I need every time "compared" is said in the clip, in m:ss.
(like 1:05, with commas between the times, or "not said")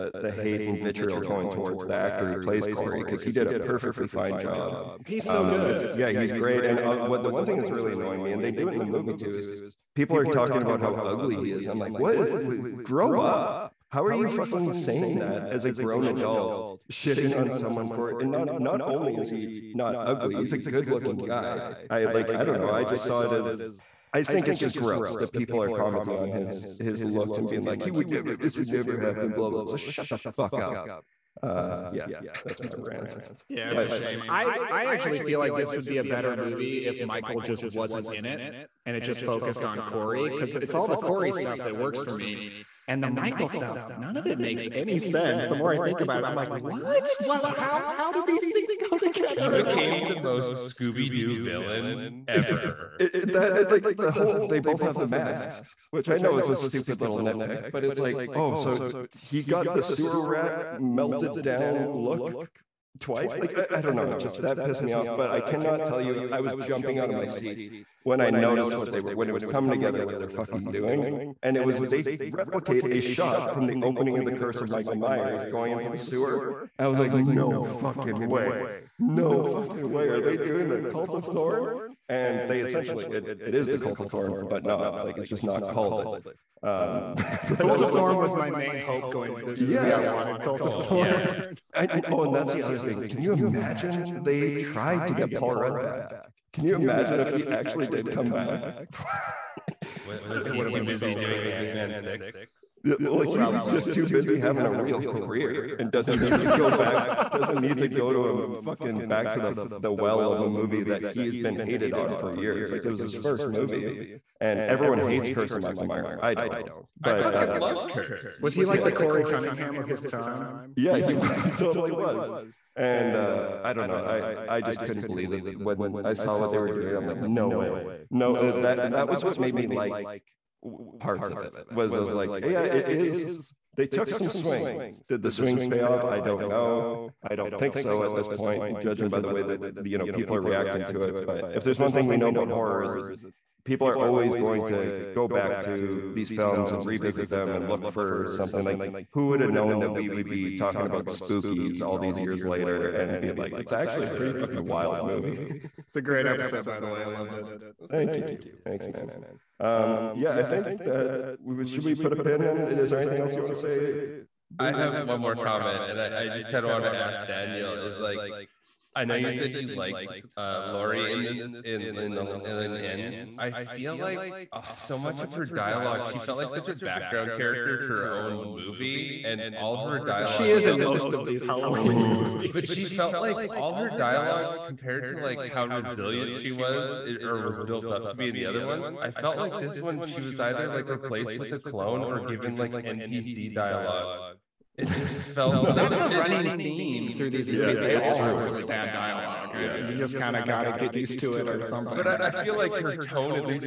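3:04.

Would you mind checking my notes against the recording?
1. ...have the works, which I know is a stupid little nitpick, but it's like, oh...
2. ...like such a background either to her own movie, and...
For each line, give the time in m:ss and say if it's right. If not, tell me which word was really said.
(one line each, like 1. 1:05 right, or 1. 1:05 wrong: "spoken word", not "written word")
1. 0:54 wrong: "masks", not "works"
2. 2:56 wrong: "character", not "either".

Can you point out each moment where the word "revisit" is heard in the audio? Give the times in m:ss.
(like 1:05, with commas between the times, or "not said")
2:26.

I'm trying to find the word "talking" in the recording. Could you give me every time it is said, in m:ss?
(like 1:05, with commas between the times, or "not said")
0:10, 2:30.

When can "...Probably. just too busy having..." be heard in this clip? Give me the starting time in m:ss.
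1:43.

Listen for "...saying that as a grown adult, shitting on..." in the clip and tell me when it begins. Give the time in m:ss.
0:14.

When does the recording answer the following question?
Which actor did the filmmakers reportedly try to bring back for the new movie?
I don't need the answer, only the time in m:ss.
1:35.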